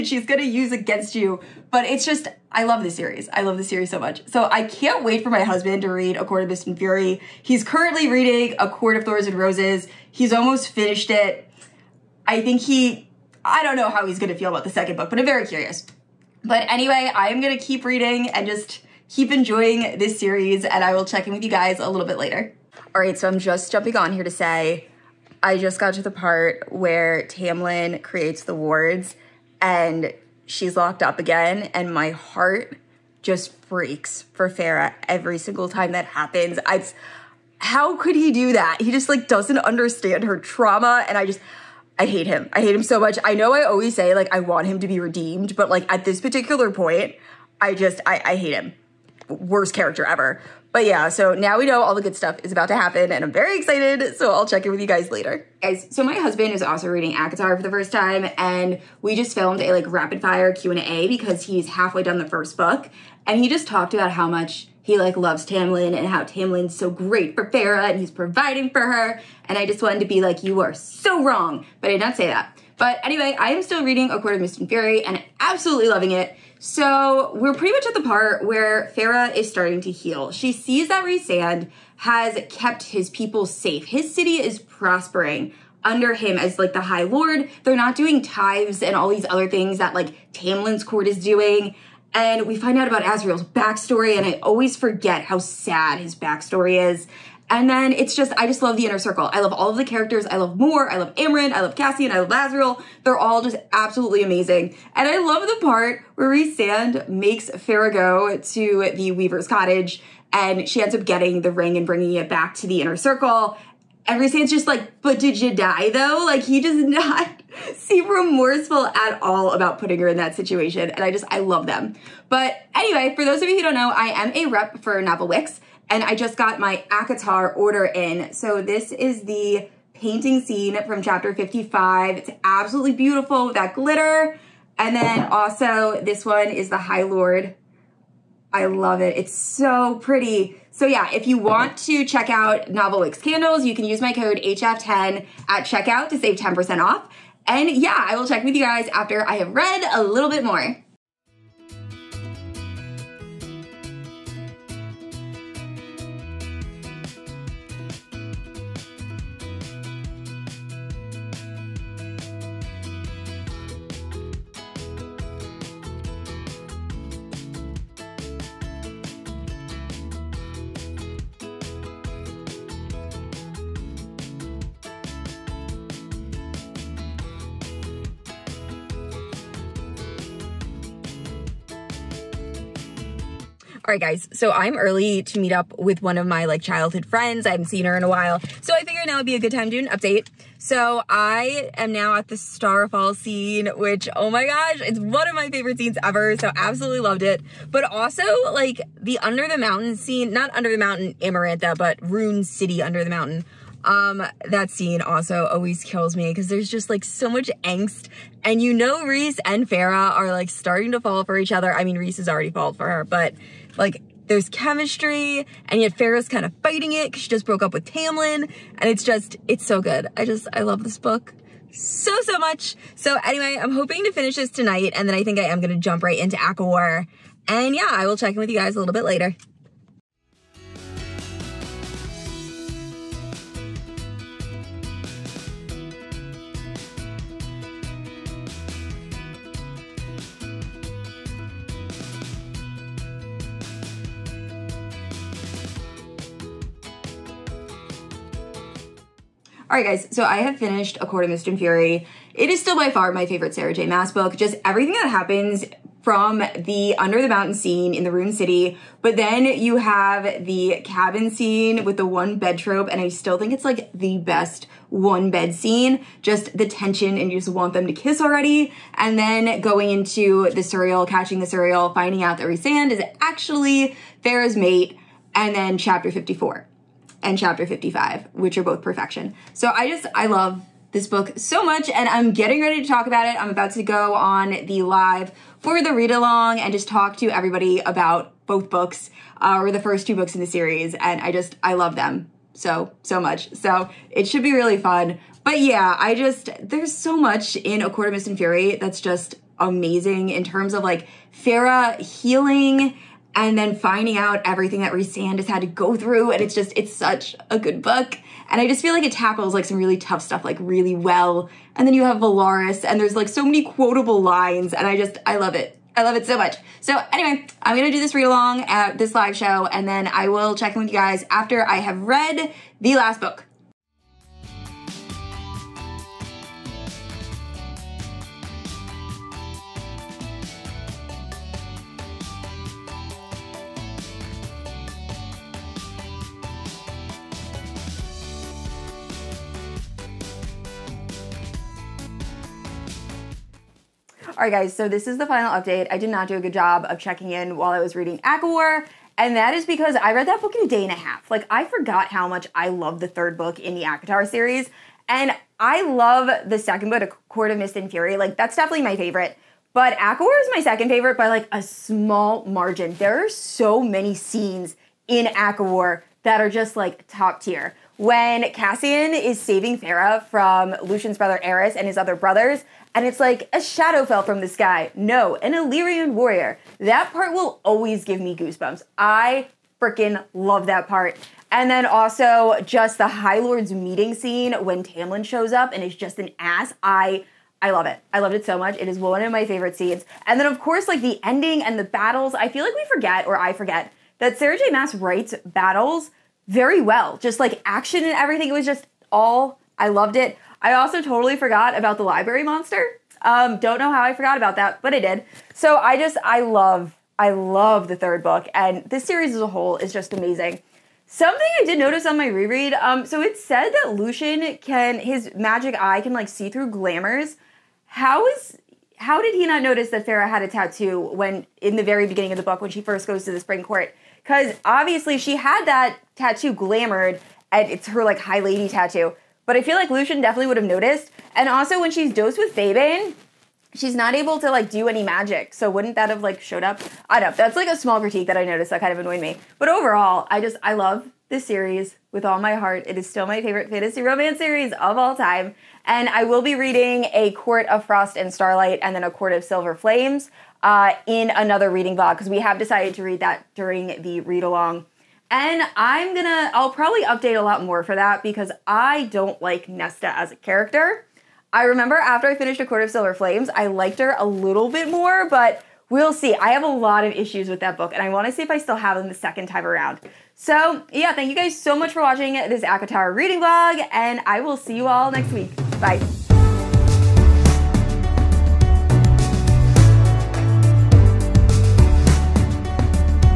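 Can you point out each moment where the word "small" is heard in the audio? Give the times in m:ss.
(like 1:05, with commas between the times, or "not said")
6:01, 7:17.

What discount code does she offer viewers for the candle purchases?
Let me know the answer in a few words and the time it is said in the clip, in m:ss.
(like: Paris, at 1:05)
HF10, at 2:24.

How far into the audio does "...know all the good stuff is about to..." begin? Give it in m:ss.
0:51.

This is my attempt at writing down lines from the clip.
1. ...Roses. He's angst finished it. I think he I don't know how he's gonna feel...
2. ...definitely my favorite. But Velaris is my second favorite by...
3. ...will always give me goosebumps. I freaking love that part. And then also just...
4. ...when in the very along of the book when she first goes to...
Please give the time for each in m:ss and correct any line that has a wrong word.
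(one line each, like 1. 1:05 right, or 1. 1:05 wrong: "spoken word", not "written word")
1. 0:09 wrong: "almost", not "angst"
2. 5:58 wrong: "ACOWAR", not "Velaris"
3. 6:17 right
4. 7:00 wrong: "beginning", not "along".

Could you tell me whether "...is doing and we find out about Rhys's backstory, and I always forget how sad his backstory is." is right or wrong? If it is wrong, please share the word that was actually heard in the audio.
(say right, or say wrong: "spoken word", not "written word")
wrong: "Azriel", not "Rhys".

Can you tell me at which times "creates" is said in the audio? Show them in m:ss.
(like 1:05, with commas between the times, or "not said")
0:28.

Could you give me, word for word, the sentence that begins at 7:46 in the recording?
I have a lot of issues with that book, and I wanna see if I still have them the second time around.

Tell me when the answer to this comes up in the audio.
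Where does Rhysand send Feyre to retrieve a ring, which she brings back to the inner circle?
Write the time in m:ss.
1:49.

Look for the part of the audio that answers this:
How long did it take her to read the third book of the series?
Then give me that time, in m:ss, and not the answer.
5:50.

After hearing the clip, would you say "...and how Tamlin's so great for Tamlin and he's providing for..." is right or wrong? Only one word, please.
wrong.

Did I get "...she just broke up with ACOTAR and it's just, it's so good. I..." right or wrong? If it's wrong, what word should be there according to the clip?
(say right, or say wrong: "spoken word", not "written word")
wrong: "Tamlin", not "ACOTAR".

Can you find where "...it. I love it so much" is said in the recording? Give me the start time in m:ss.
5:15.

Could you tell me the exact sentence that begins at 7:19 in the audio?
But overall, I just I love this series with all my heart.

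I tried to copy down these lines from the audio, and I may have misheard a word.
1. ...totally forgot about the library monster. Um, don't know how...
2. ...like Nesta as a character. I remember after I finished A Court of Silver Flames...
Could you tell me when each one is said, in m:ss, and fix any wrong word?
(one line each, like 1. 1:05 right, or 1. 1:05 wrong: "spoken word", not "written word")
1. 6:41 right
2. 7:39 right.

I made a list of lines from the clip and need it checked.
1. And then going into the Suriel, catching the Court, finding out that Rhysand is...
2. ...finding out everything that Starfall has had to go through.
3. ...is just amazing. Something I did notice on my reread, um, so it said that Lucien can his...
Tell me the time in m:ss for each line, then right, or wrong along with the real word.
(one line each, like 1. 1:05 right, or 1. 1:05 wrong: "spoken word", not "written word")
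1. 4:28 wrong: "Suriel", not "Court"
2. 5:03 wrong: "Rhysand", not "Starfall"
3. 6:49 right.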